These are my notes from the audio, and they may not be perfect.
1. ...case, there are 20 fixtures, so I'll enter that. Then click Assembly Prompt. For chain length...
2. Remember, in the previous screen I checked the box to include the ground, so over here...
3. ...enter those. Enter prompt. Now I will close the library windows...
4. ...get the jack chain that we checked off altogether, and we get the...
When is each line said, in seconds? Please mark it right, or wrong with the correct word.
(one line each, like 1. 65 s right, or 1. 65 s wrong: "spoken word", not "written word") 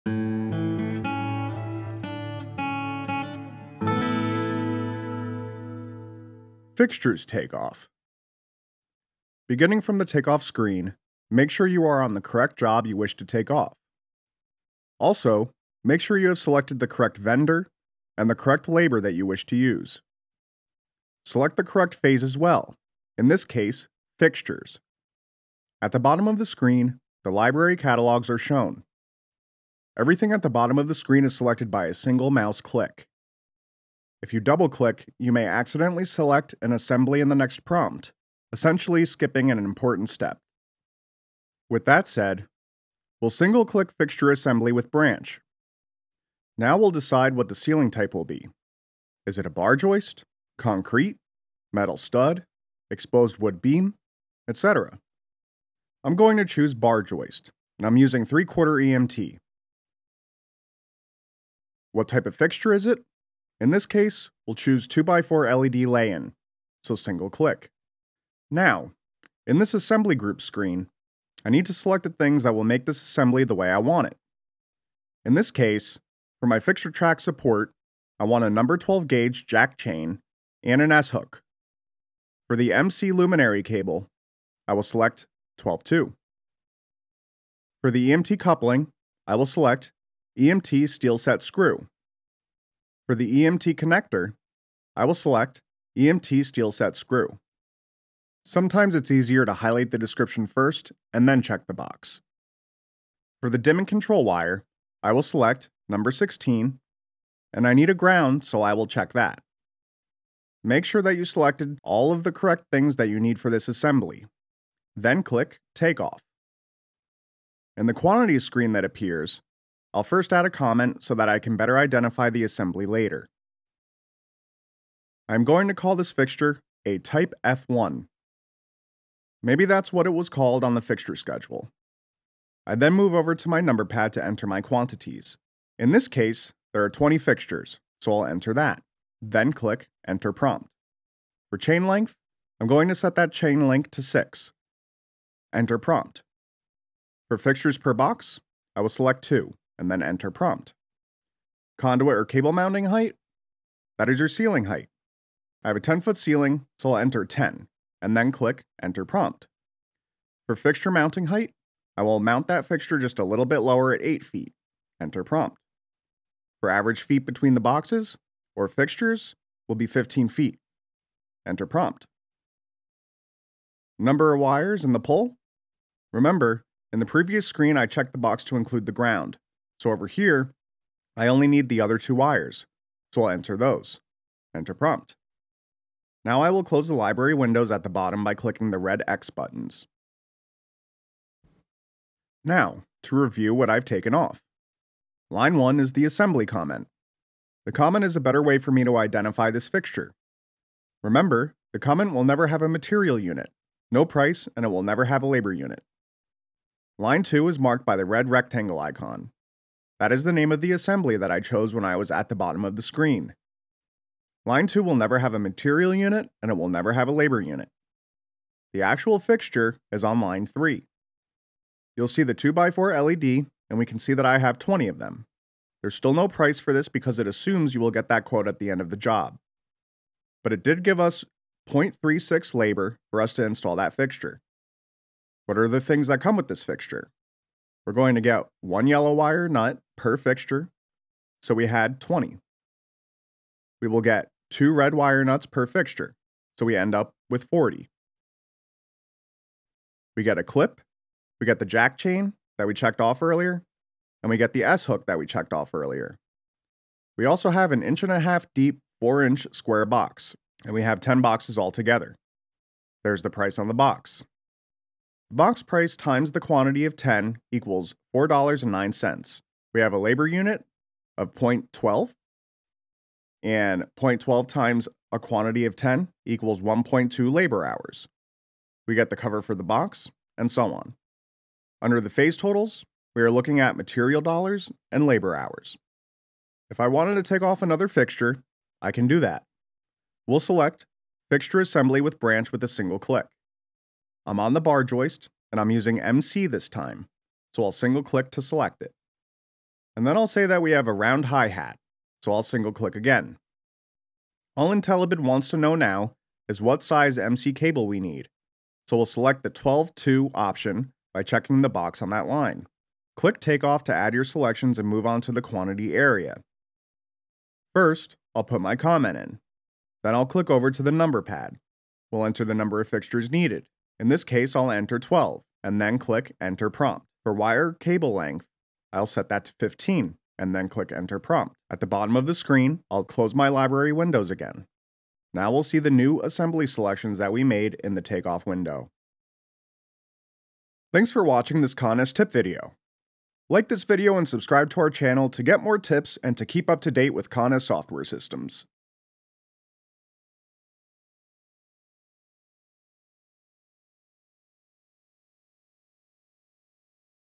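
1. 136 s wrong: "Enter", not "Assembly"
2. 176 s right
3. 183 s right
4. 251 s wrong: "earlier", not "altogether".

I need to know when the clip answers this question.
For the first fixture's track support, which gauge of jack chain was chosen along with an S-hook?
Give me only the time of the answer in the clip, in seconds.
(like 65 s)
78 s.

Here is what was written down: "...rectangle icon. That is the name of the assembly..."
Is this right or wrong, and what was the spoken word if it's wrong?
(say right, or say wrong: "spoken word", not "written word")
right.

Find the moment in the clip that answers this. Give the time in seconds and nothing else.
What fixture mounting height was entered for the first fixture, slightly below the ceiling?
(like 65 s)
164 s.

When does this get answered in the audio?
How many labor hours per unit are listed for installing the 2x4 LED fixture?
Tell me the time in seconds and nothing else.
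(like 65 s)
231 s.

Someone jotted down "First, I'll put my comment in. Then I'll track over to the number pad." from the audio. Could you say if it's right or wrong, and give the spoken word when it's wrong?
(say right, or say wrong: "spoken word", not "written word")
wrong: "click", not "track".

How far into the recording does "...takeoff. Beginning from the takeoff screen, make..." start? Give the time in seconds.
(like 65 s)
7 s.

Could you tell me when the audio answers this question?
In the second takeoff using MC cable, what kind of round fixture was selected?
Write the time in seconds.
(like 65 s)
300 s.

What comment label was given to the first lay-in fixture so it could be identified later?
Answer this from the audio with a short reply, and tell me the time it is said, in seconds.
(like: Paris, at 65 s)
Type F1, at 126 s.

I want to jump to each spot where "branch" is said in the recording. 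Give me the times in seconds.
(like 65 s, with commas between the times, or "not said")
44 s, 292 s.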